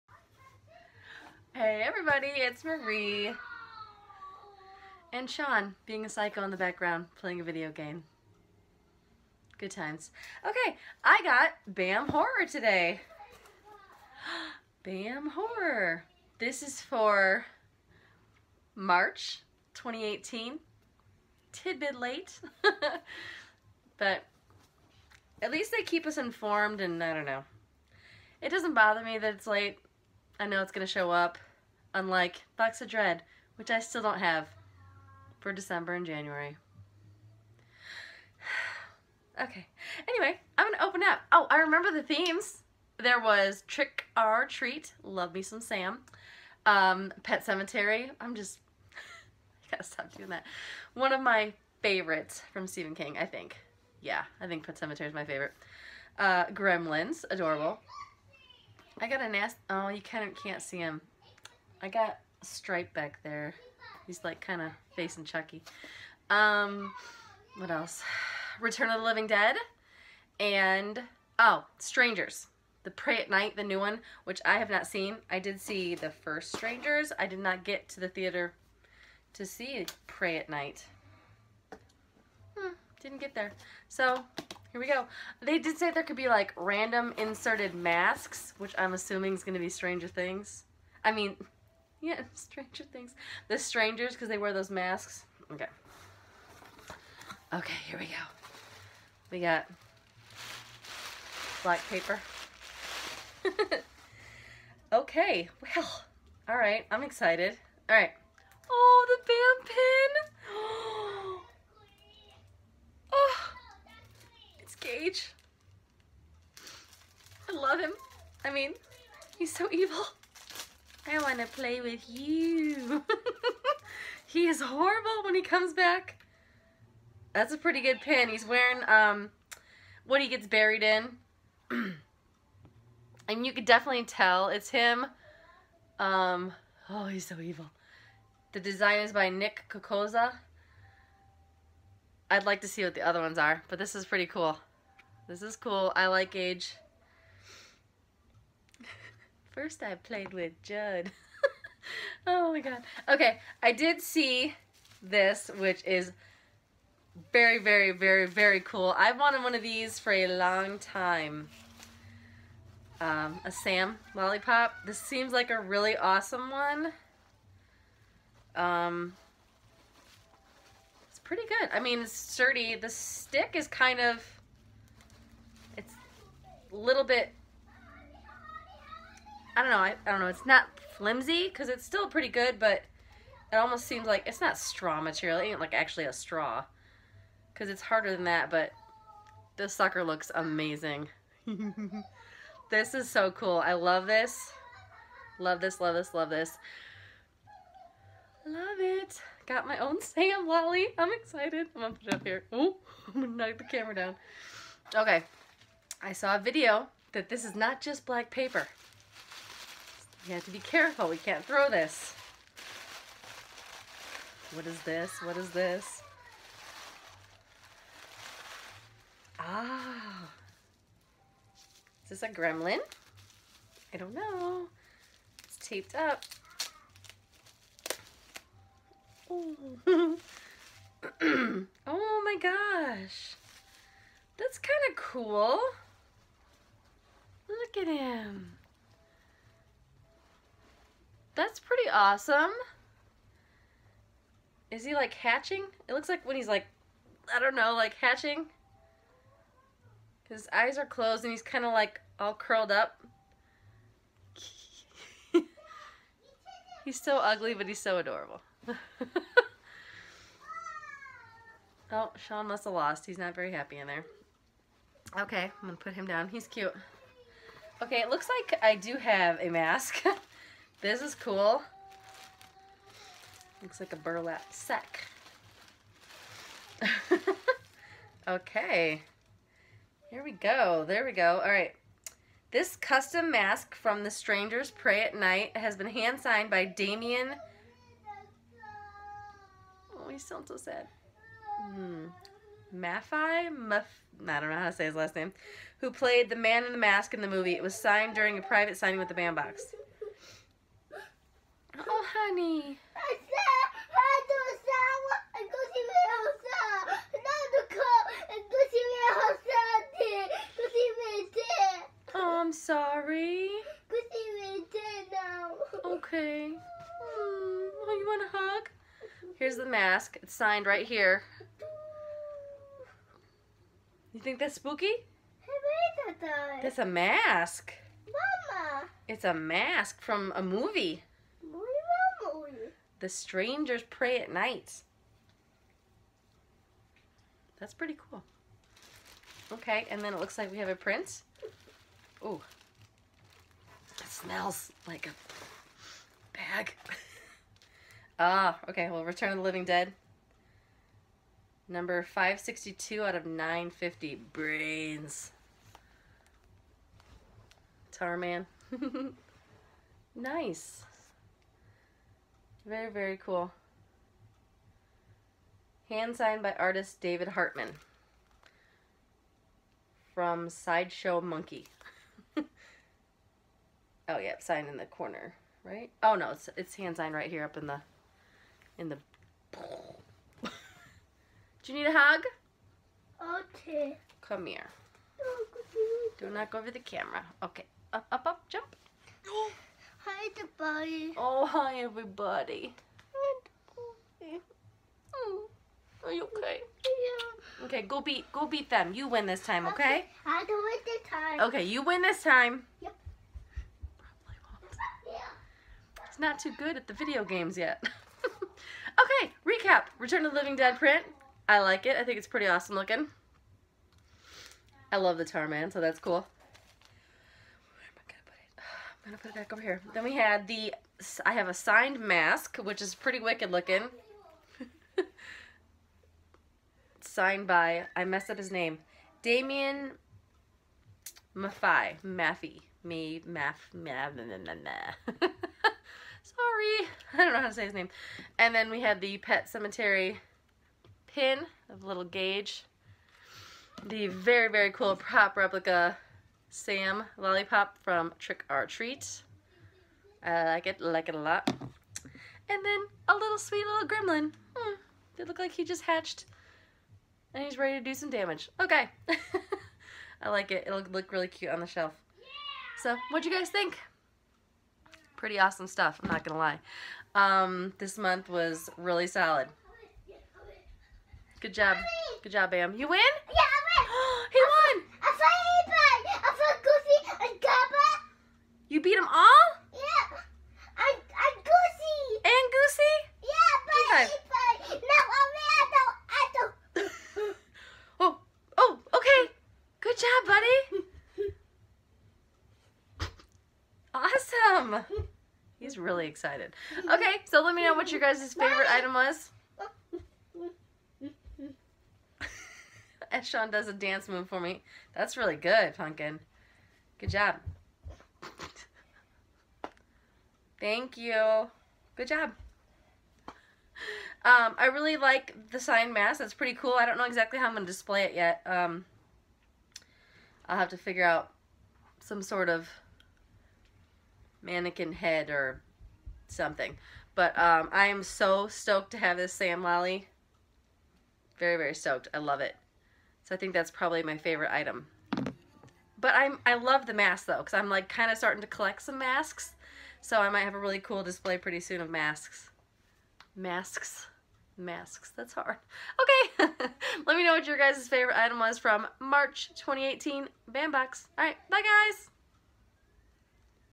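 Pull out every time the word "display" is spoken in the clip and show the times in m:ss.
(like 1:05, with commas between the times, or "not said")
8:37, 9:01.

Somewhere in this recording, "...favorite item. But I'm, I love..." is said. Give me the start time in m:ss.
8:54.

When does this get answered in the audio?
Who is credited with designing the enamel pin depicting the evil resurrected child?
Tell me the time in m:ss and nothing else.
2:19.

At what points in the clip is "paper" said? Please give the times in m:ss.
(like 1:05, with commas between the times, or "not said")
1:41, 3:28.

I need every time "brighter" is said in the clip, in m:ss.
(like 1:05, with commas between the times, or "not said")
not said.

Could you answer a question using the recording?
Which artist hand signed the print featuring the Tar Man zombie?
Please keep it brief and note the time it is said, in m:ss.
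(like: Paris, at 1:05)
David Hartman, at 6:07.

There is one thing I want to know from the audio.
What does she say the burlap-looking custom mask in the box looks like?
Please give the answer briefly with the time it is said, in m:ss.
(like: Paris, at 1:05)
A burlap sack, at 4:33.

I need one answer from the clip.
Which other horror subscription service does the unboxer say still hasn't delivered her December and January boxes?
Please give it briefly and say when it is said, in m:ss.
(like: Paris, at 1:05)
Box of Dread, at 0:32.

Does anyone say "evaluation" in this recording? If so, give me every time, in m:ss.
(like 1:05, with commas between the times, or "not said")
not said.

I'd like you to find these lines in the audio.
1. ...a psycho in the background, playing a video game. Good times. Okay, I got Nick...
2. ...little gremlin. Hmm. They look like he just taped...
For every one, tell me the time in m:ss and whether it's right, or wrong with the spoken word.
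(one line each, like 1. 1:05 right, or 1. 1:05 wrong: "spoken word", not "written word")
1. 0:06 wrong: "BAM", not "Nick"
2. 7:33 wrong: "hatched", not "taped".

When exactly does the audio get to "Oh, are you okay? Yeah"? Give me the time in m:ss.
6:35.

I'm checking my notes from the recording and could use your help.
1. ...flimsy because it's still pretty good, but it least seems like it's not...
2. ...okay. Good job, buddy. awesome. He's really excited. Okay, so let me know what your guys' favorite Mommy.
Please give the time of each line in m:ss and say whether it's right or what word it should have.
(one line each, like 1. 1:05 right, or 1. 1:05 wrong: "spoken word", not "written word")
1. 3:00 wrong: "almost", not "least"
2. 8:08 right.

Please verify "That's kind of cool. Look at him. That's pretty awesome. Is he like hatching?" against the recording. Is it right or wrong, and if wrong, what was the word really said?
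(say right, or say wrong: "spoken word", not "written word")
right.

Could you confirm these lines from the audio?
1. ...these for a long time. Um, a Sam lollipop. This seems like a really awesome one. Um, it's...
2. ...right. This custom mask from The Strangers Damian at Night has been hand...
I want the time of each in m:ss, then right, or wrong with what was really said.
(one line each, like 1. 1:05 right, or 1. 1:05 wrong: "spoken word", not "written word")
1. 2:39 right
2. 4:41 wrong: "Prey", not "Damian".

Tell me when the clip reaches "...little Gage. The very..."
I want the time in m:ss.
7:21.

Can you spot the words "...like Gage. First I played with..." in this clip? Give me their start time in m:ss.
2:26.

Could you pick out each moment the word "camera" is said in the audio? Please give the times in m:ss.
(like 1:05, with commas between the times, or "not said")
3:23, 6:26.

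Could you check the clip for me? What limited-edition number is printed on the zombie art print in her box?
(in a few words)
562.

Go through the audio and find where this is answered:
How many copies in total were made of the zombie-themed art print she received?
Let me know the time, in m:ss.
5:53.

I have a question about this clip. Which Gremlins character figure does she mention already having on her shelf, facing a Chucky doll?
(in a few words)
Stripe.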